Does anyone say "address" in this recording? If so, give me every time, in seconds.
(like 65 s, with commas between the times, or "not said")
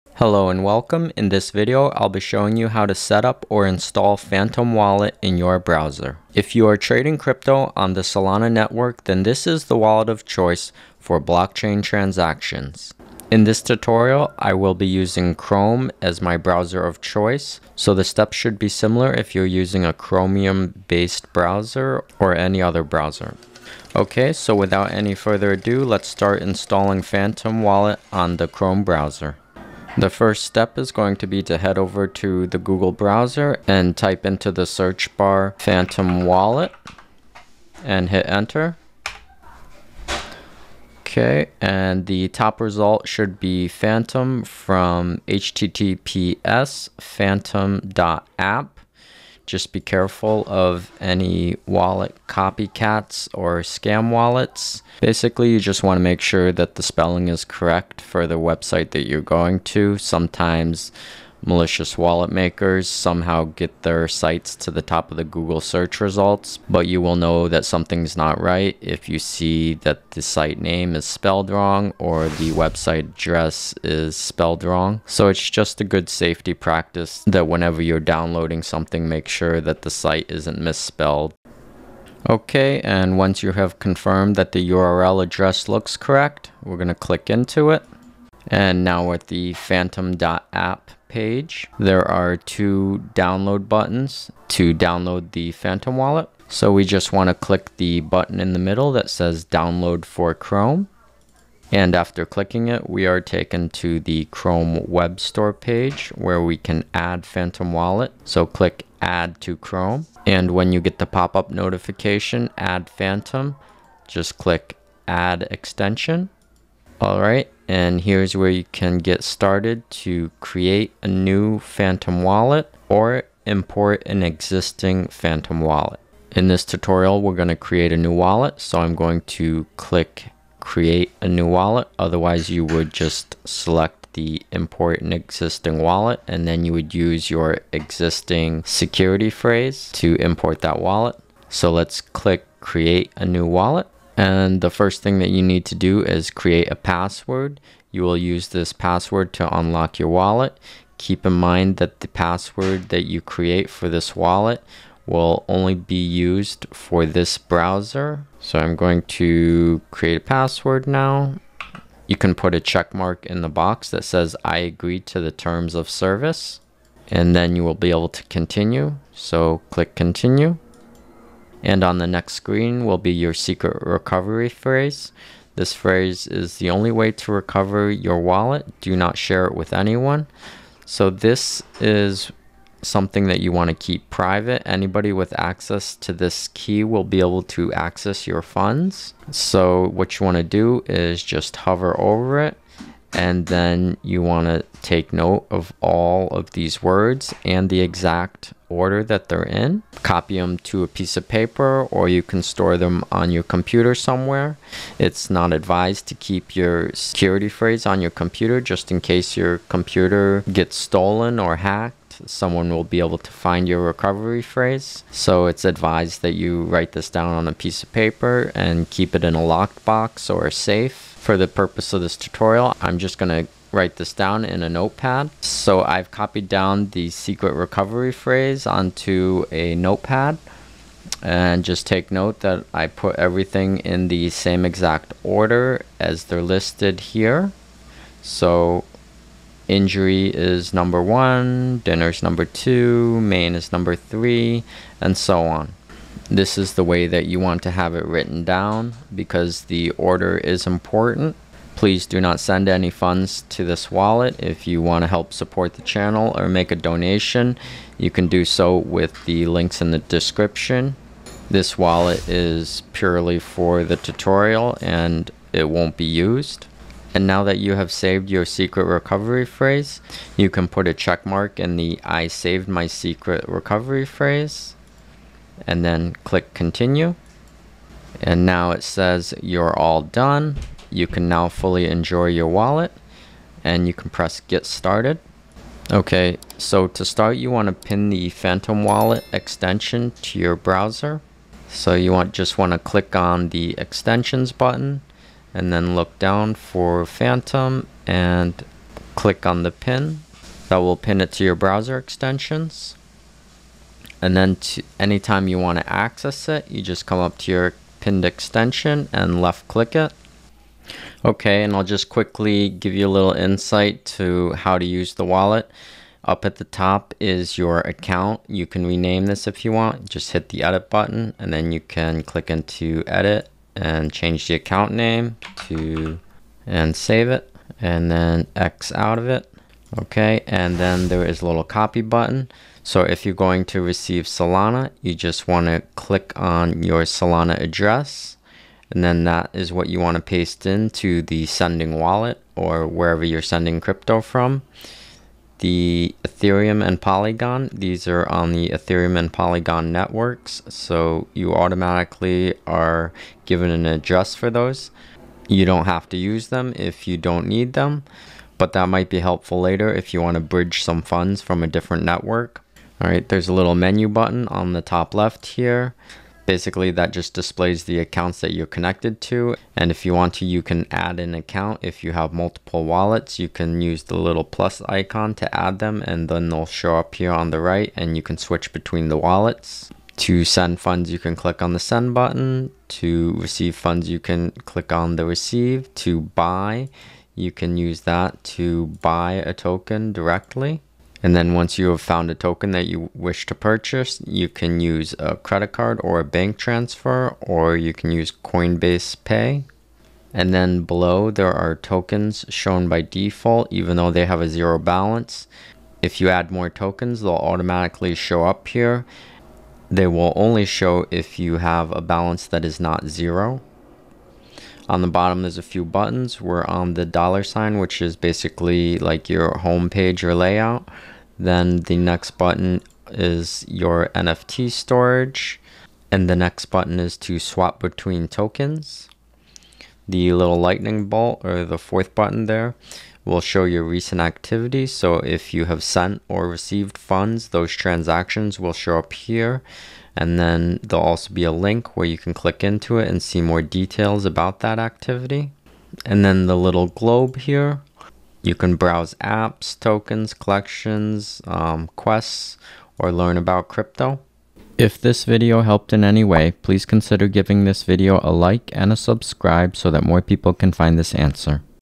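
73 s, 85 s, 337 s, 353 s.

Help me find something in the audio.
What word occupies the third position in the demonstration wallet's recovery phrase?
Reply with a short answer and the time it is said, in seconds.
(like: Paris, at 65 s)
main, at 243 s.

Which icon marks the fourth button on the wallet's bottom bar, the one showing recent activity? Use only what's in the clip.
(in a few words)
lightning bolt.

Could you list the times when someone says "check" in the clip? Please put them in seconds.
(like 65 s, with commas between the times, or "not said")
162 s, 270 s.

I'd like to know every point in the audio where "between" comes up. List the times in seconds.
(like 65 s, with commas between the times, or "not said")
378 s, 427 s.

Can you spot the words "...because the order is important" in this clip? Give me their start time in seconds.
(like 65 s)
249 s.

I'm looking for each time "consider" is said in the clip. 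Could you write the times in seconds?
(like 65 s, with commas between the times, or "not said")
456 s.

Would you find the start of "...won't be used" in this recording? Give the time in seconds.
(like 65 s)
265 s.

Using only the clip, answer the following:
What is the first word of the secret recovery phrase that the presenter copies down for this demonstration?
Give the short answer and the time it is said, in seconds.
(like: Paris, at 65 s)
injury, at 239 s.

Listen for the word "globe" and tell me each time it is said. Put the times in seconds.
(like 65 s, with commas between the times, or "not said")
446 s.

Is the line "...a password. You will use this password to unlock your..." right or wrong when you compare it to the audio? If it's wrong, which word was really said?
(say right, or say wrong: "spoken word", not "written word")
right.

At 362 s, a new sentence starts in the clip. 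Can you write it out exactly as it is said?
All right, there's a little menu button on the top left here.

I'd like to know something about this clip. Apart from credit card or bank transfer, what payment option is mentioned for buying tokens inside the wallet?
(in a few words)
Coinbase Pay.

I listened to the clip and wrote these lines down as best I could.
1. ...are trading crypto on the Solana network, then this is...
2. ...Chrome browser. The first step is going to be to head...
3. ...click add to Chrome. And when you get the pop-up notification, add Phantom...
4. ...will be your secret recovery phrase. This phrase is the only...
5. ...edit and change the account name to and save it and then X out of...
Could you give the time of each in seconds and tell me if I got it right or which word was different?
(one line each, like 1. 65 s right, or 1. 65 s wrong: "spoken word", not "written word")
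1. 6 s right
2. 28 s right
3. 108 s right
4. 172 s right
5. 323 s right.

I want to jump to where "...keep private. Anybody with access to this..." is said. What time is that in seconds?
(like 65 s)
183 s.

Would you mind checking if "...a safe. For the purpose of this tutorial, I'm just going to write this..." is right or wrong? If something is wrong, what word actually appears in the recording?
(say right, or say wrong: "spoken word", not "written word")
right.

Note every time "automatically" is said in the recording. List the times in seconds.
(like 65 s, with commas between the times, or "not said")
351 s, 407 s.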